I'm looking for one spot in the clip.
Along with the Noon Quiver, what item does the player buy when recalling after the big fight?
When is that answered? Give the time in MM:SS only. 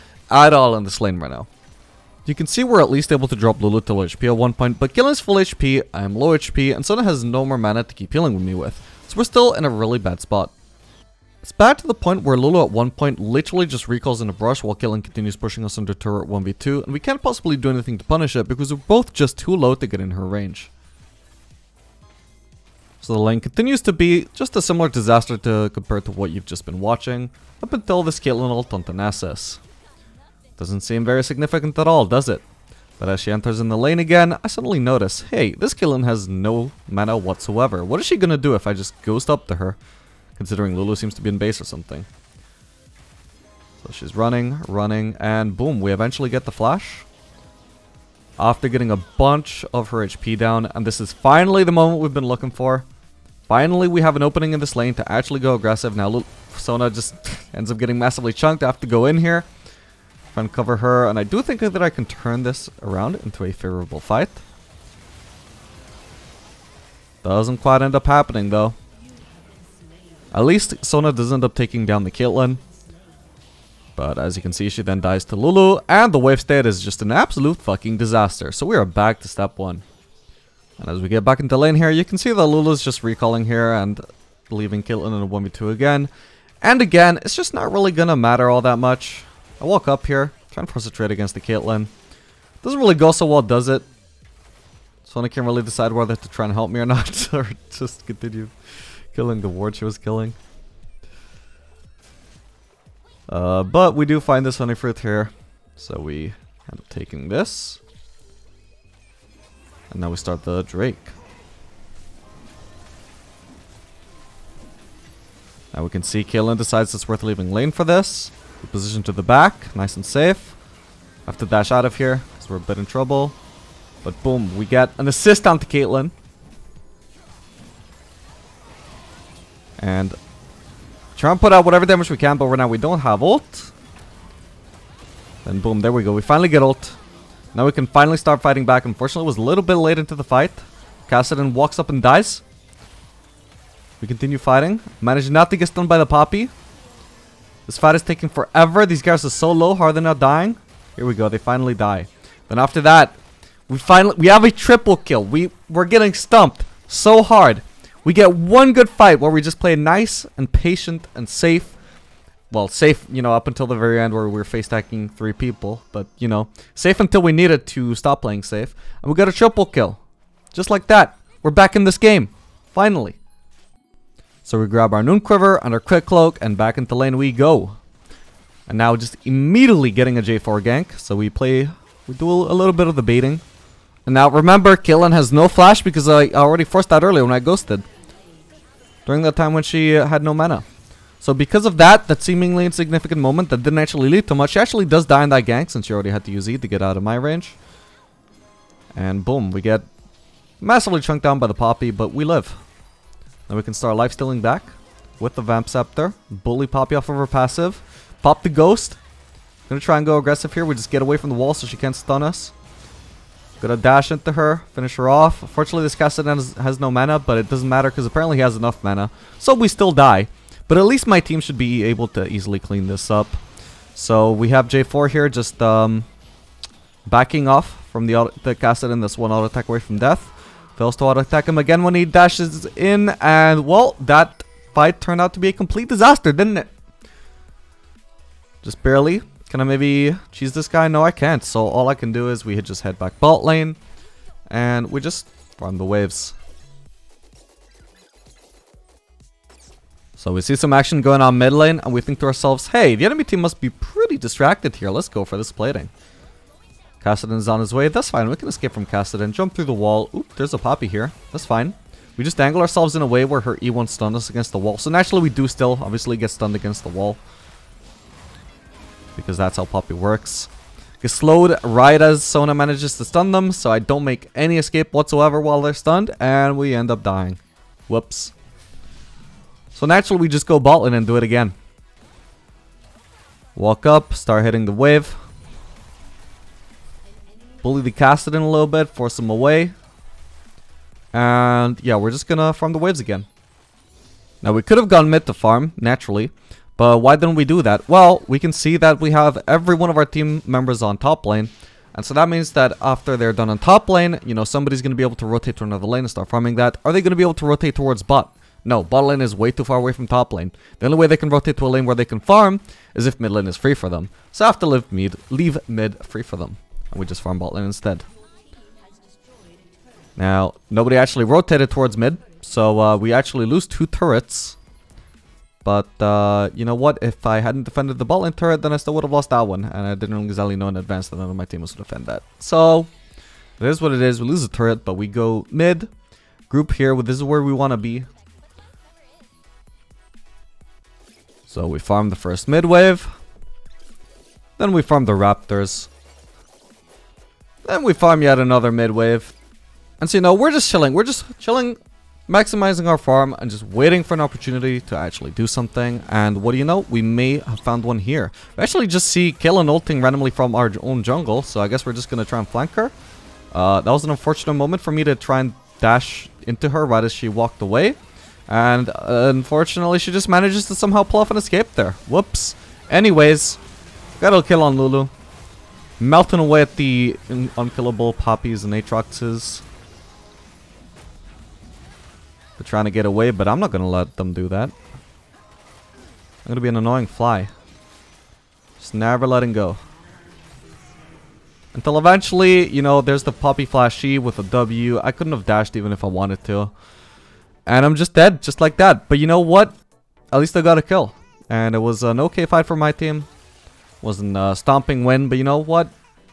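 02:55.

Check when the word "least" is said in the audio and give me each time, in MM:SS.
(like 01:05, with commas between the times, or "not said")
00:02, 01:10, 03:40, 06:40.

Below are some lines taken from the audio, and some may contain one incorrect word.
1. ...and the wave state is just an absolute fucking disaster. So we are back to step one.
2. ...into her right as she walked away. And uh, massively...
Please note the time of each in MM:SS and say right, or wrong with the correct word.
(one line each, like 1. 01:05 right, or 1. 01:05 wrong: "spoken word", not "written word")
1. 01:15 right
2. 06:06 wrong: "unfortunately", not "massively".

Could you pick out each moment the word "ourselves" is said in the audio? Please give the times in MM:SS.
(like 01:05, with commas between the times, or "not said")
04:12, 04:22.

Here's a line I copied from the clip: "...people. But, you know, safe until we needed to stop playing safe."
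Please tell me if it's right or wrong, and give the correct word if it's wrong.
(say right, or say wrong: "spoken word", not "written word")
right.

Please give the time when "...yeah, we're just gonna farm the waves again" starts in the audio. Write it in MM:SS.
04:51.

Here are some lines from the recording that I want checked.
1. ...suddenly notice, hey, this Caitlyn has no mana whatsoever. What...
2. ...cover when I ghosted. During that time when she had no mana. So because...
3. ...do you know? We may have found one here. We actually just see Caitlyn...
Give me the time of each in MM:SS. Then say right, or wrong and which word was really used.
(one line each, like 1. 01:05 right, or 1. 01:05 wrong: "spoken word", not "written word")
1. 00:34 right
2. 03:07 wrong: "earlier", not "cover"
3. 05:56 right.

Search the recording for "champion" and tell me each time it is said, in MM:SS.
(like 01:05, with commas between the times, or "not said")
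not said.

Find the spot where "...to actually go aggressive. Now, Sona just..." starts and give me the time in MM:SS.
00:54.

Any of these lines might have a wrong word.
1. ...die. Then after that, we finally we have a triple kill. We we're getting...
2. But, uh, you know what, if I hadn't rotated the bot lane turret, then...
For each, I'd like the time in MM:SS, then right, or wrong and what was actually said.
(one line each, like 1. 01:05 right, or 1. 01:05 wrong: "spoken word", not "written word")
1. 02:31 right
2. 05:25 wrong: "defended", not "rotated".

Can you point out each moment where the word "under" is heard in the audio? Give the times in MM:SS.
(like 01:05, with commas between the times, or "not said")
00:15.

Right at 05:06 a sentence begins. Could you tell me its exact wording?
Are they going to be able to rotate towards bot?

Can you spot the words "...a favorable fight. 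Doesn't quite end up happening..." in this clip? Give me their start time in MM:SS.
01:03.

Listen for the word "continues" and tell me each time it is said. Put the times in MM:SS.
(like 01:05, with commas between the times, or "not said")
00:15, 00:23, 01:38, 02:24.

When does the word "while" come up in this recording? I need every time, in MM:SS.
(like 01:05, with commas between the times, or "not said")
00:14, 04:35.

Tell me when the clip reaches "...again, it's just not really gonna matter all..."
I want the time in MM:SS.
01:26.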